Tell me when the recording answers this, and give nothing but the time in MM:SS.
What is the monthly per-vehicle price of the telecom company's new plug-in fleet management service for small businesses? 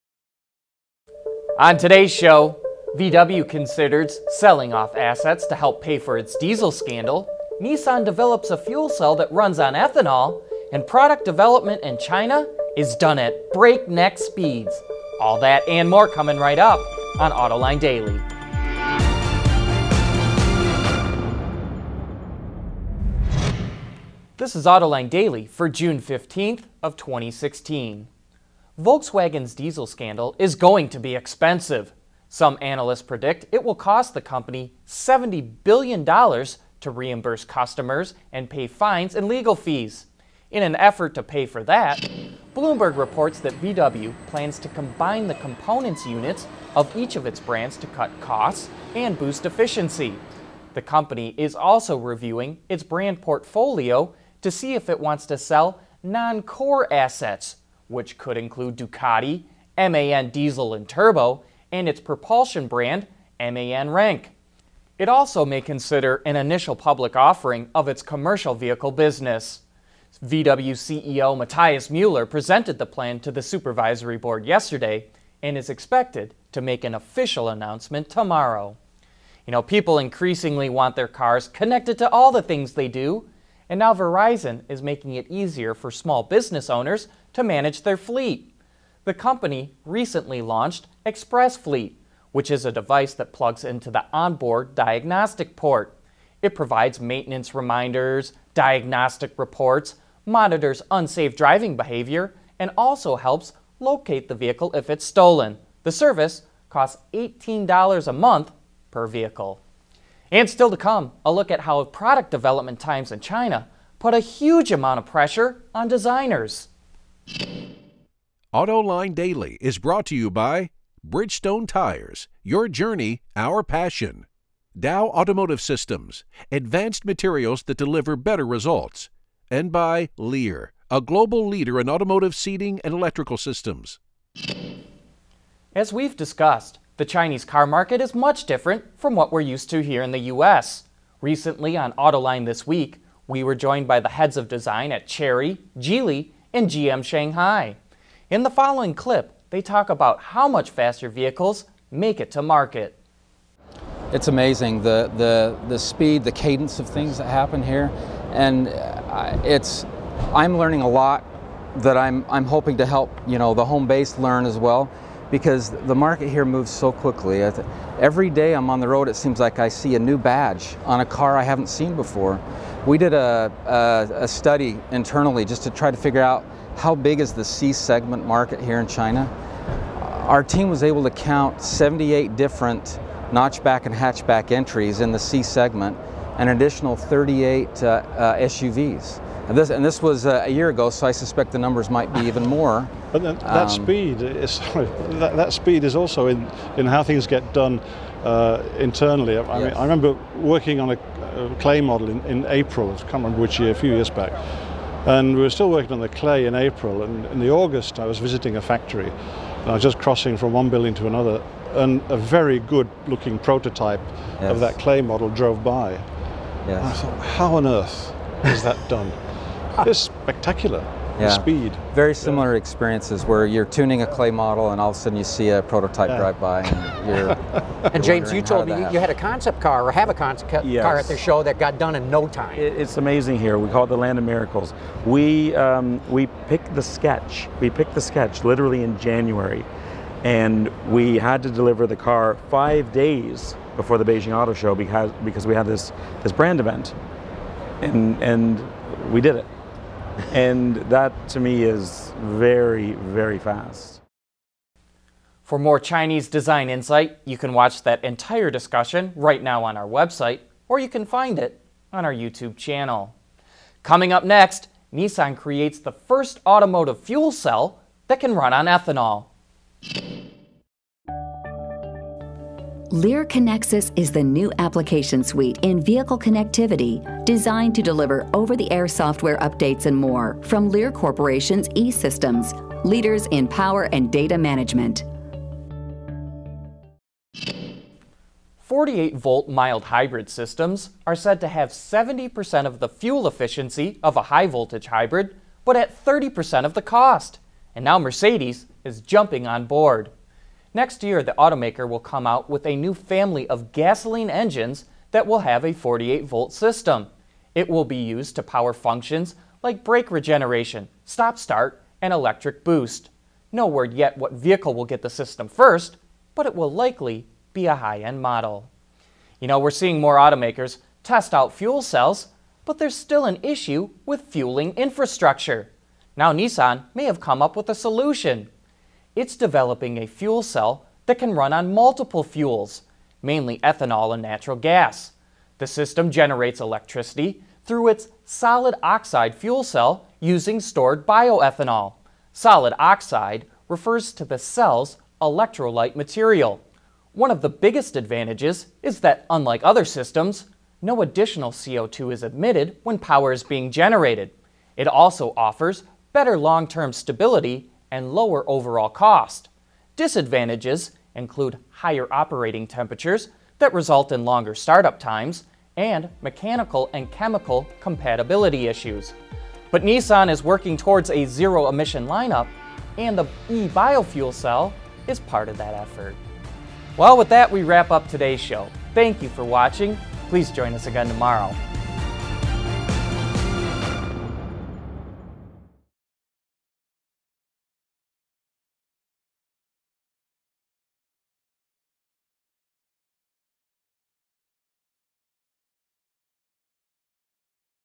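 01:47.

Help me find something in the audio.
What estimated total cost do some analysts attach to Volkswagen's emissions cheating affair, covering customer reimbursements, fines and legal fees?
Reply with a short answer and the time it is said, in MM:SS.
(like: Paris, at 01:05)
$70 billion, at 00:34.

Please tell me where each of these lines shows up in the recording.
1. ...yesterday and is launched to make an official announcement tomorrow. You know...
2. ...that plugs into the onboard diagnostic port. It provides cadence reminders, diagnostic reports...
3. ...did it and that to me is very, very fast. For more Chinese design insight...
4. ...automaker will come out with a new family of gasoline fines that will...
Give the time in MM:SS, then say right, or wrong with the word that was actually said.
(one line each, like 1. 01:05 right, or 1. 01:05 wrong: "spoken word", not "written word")
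1. 01:14 wrong: "expected", not "launched"
2. 01:33 wrong: "maintenance", not "cadence"
3. 04:09 right
4. 05:01 wrong: "engines", not "fines".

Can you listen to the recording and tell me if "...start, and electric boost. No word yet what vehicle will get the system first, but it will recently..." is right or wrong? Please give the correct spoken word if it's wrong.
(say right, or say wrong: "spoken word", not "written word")
wrong: "likely", not "recently".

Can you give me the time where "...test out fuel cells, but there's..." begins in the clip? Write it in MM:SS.
05:21.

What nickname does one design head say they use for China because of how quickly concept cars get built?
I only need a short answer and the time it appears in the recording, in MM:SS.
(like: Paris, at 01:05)
the land of miracles, at 03:53.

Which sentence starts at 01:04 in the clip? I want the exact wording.
It also may consider an initial public offering of its commercial vehicle business.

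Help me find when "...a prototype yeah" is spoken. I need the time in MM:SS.
03:45.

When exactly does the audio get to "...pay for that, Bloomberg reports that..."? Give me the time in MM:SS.
00:41.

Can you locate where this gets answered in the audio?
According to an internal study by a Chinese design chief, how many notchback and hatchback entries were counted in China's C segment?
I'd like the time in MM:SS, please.
03:01.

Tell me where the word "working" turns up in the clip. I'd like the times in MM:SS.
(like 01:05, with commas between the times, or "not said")
03:20, 03:25, 06:10.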